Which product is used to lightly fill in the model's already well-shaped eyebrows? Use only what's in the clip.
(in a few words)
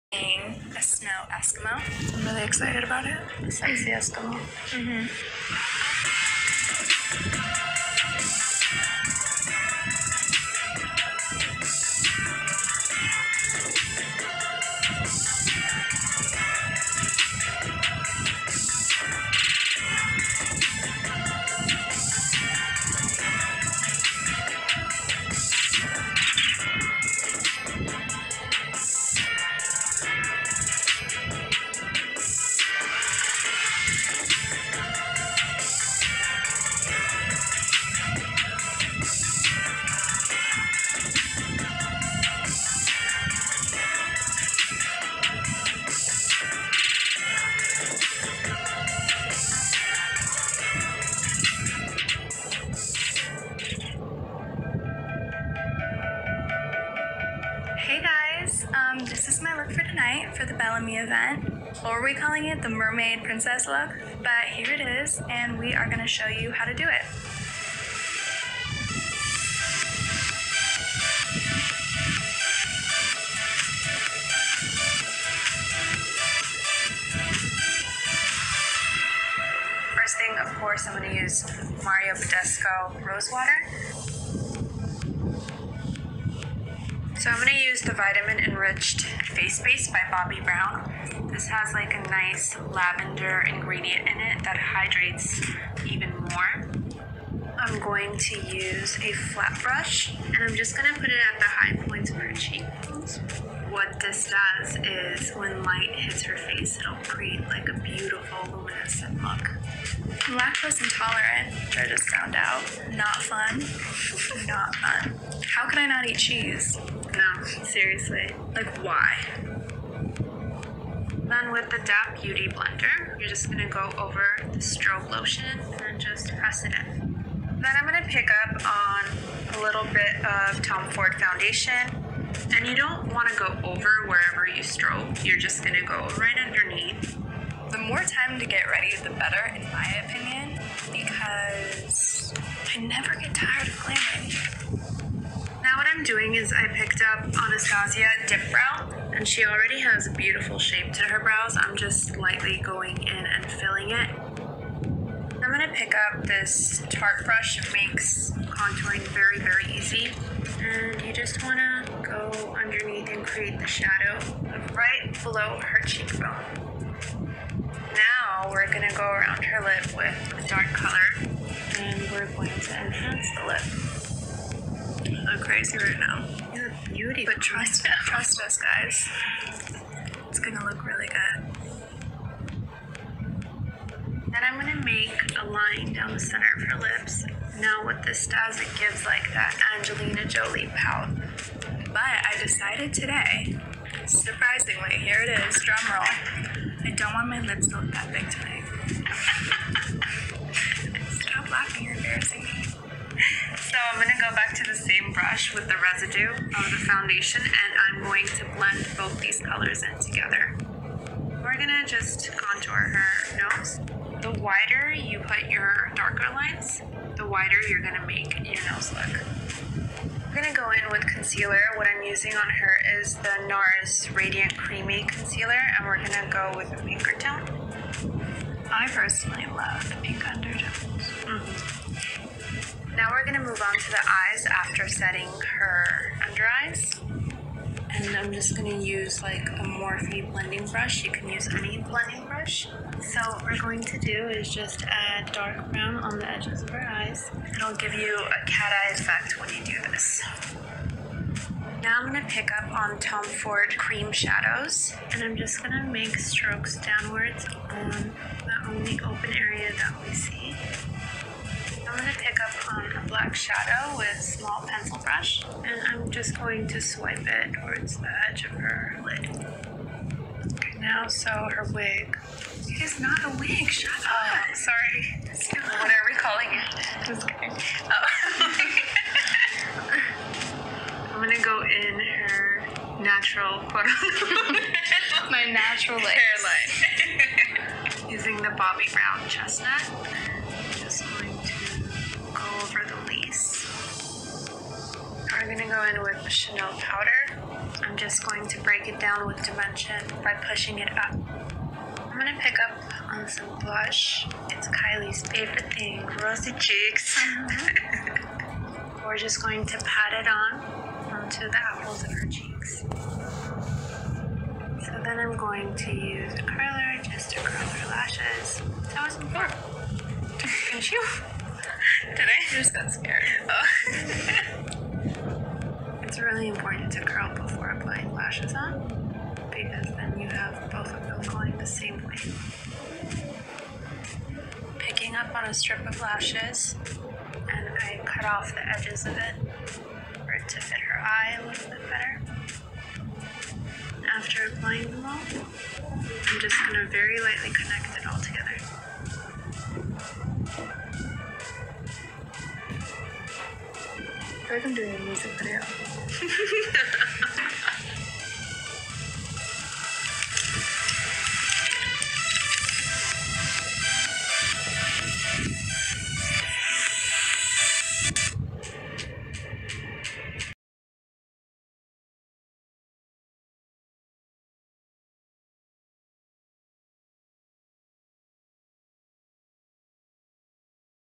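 Anastasia Dip Brow.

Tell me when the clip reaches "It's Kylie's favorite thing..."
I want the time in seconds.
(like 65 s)
304 s.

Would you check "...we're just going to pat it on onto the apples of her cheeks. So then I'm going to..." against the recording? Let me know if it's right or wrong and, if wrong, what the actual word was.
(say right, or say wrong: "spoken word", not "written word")
right.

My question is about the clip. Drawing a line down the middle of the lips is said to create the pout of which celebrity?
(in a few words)
Angelina Jolie.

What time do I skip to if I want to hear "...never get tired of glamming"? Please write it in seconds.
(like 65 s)
142 s.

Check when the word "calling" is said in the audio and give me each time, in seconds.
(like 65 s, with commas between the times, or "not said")
62 s, 276 s.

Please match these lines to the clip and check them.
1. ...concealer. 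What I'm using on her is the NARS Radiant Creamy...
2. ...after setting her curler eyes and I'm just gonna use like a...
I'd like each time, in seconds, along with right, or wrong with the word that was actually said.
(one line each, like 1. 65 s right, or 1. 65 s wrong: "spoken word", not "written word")
1. 221 s right
2. 234 s wrong: "under", not "curler".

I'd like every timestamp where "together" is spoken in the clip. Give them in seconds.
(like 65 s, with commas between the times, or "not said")
209 s, 348 s.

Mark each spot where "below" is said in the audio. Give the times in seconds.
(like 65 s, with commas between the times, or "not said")
165 s.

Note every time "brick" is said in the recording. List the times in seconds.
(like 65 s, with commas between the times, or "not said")
not said.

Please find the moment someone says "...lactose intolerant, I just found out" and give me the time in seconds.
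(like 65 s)
110 s.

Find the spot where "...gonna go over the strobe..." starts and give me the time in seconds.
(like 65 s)
123 s.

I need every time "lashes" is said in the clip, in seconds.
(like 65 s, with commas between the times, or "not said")
317 s, 328 s, 335 s.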